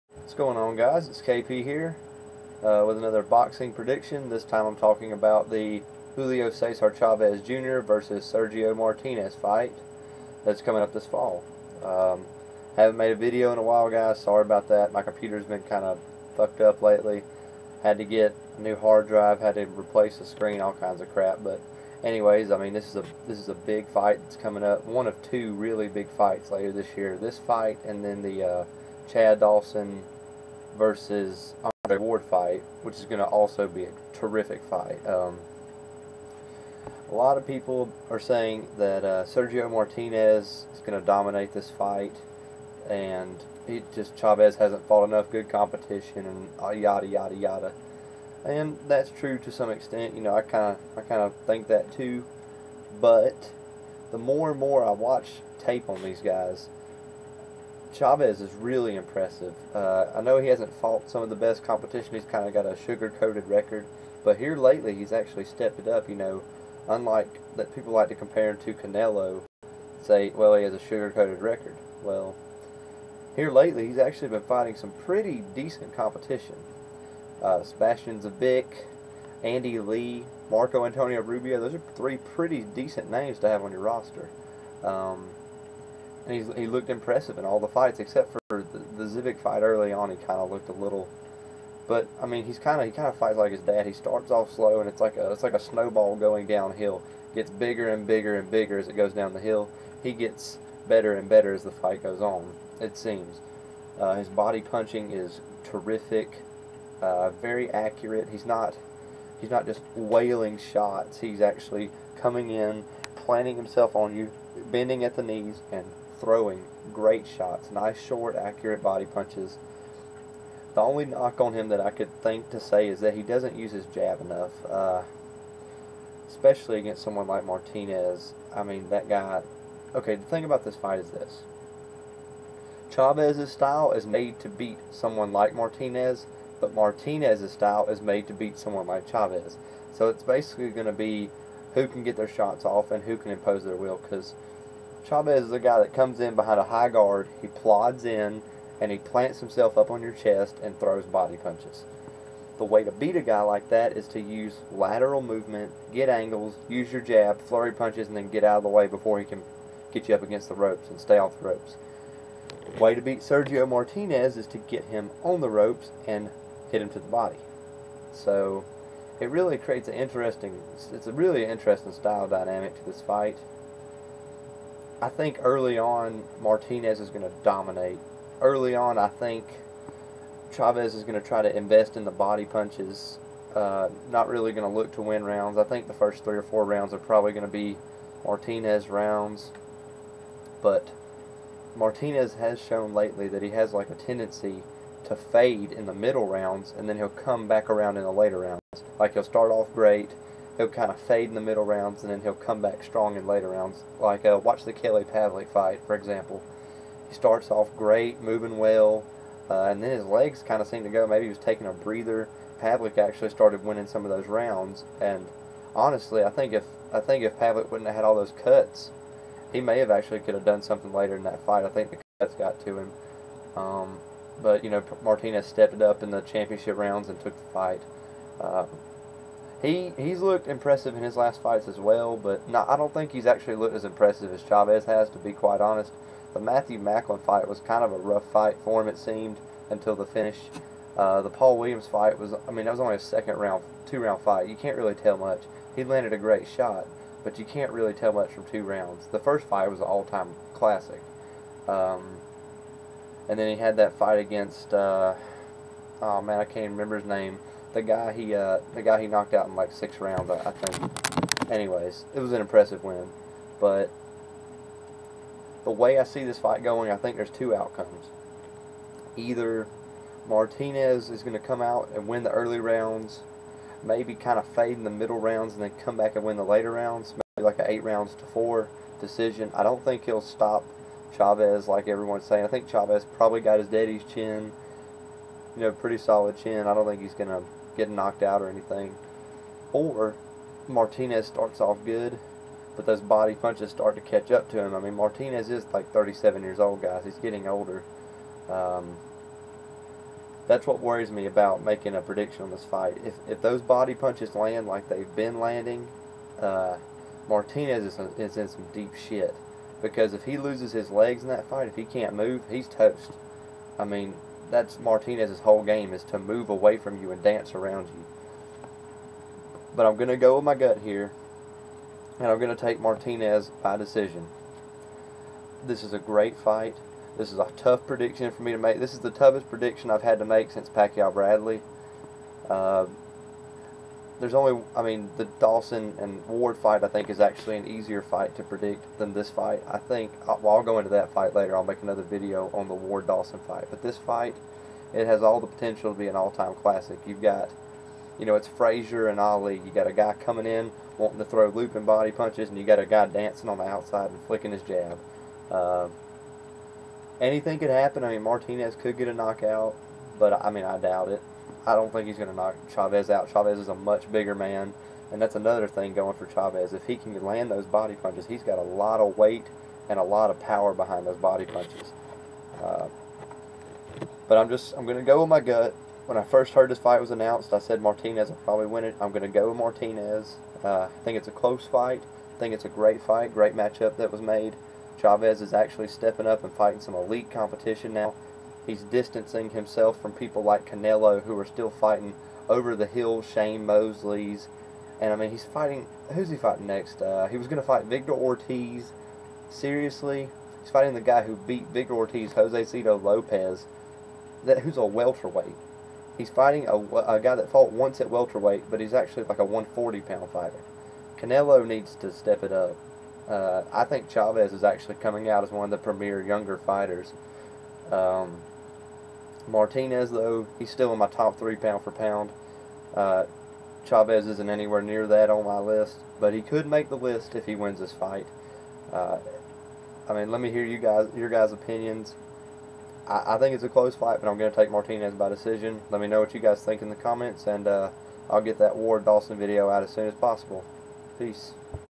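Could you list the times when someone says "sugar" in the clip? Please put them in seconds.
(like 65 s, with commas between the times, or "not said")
62 s, 70 s.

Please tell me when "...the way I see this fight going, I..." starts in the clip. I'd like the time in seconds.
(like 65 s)
265 s.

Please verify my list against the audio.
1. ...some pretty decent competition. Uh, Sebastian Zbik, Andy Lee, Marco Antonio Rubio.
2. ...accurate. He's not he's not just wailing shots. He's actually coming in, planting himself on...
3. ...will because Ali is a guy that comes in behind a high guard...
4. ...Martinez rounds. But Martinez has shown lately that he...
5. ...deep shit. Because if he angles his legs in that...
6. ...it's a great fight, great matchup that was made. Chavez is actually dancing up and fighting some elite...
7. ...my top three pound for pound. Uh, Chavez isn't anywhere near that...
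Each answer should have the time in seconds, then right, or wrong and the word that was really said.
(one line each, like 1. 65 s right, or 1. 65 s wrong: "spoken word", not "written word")
1. 74 s right
2. 107 s right
3. 143 s wrong: "Chavez", not "Ali"
4. 188 s right
5. 308 s wrong: "loses", not "angles"
6. 382 s wrong: "stepping", not "dancing"
7. 420 s right.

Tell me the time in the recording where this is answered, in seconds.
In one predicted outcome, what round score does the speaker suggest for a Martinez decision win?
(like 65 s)
277 s.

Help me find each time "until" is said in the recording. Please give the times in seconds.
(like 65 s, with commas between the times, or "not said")
239 s.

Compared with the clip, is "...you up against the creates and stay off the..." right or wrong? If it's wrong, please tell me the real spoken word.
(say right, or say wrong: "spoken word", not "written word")
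wrong: "ropes", not "creates".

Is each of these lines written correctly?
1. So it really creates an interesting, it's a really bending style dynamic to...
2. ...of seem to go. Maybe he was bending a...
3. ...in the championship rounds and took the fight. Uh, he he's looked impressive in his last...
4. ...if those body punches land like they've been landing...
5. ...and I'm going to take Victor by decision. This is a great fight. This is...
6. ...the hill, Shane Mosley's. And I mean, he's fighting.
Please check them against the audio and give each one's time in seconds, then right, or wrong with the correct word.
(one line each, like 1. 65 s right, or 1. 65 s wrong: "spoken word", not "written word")
1. 168 s wrong: "interesting", not "bending"
2. 210 s wrong: "taking", not "bending"
3. 226 s right
4. 303 s right
5. 322 s wrong: "Martinez", not "Victor"
6. 392 s right.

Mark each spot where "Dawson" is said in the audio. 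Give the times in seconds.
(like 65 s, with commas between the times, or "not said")
29 s, 335 s, 343 s, 439 s.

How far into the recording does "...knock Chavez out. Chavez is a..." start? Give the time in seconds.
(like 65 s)
362 s.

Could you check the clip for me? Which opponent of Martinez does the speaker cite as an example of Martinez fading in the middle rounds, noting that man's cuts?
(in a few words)
Kelly Pavlik.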